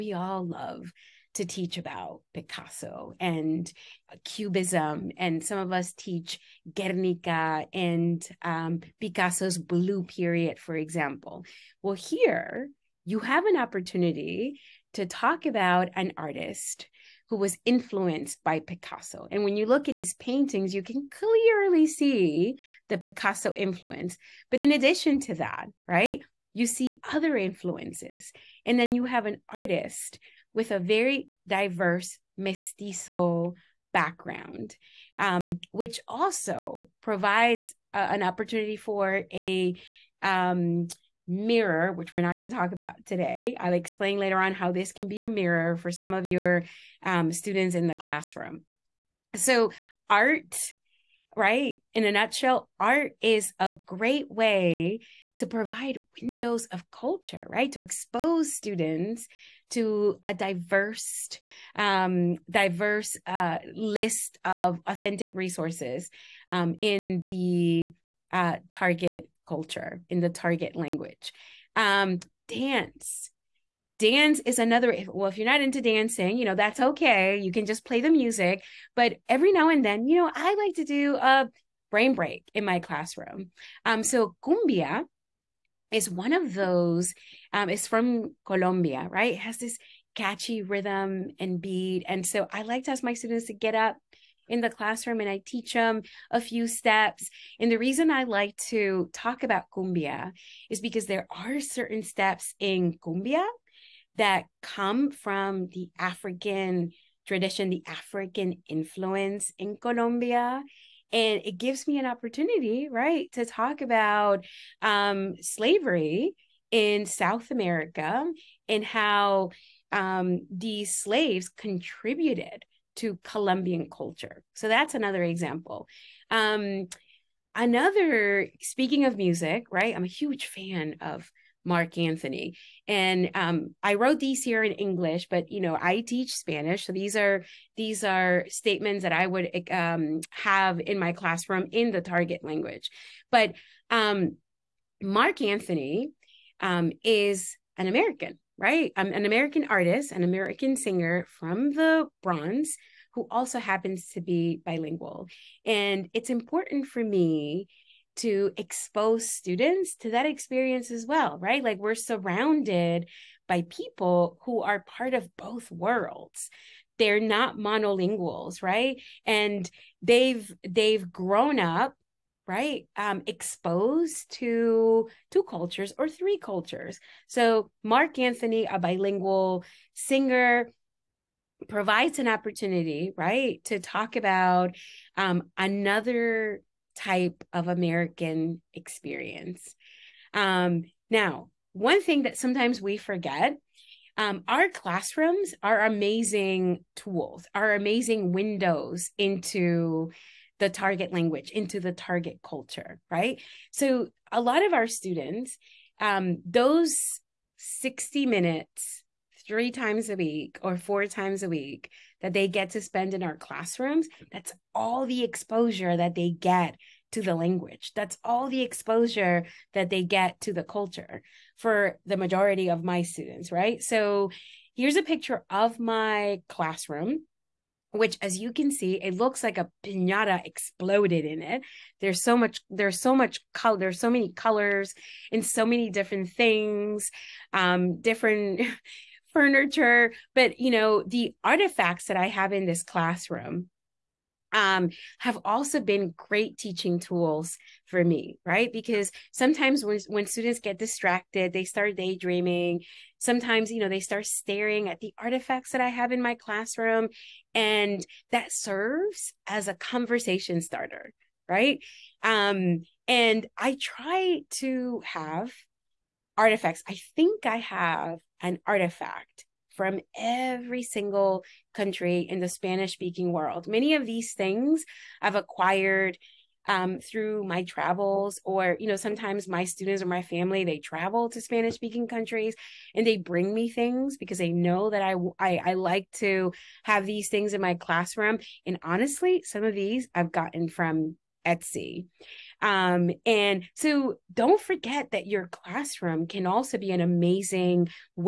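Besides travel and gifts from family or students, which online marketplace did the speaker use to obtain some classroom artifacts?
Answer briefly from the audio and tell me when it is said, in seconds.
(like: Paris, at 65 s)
Etsy, at 291 s.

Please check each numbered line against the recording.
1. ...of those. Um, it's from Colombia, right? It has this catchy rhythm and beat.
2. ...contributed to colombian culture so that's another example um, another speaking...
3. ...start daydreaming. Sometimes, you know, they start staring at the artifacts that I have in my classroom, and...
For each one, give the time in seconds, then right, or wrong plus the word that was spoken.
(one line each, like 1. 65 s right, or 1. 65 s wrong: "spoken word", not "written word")
1. 86 s right
2. 121 s right
3. 251 s right.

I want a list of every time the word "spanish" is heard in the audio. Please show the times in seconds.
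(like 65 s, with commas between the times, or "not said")
136 s, 272 s, 281 s.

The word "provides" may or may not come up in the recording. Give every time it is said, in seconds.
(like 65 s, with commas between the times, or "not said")
37 s, 55 s, 181 s.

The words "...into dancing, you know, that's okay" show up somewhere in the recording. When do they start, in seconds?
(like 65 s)
75 s.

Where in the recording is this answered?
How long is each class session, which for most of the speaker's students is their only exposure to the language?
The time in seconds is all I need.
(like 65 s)
207 s.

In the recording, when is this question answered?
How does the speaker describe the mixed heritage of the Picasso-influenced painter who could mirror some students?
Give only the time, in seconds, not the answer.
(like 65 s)
32 s.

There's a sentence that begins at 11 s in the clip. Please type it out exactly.
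Well, here you have an opportunity to talk about an artist who was influenced by Picasso.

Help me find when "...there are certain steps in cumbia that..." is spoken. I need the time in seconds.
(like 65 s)
101 s.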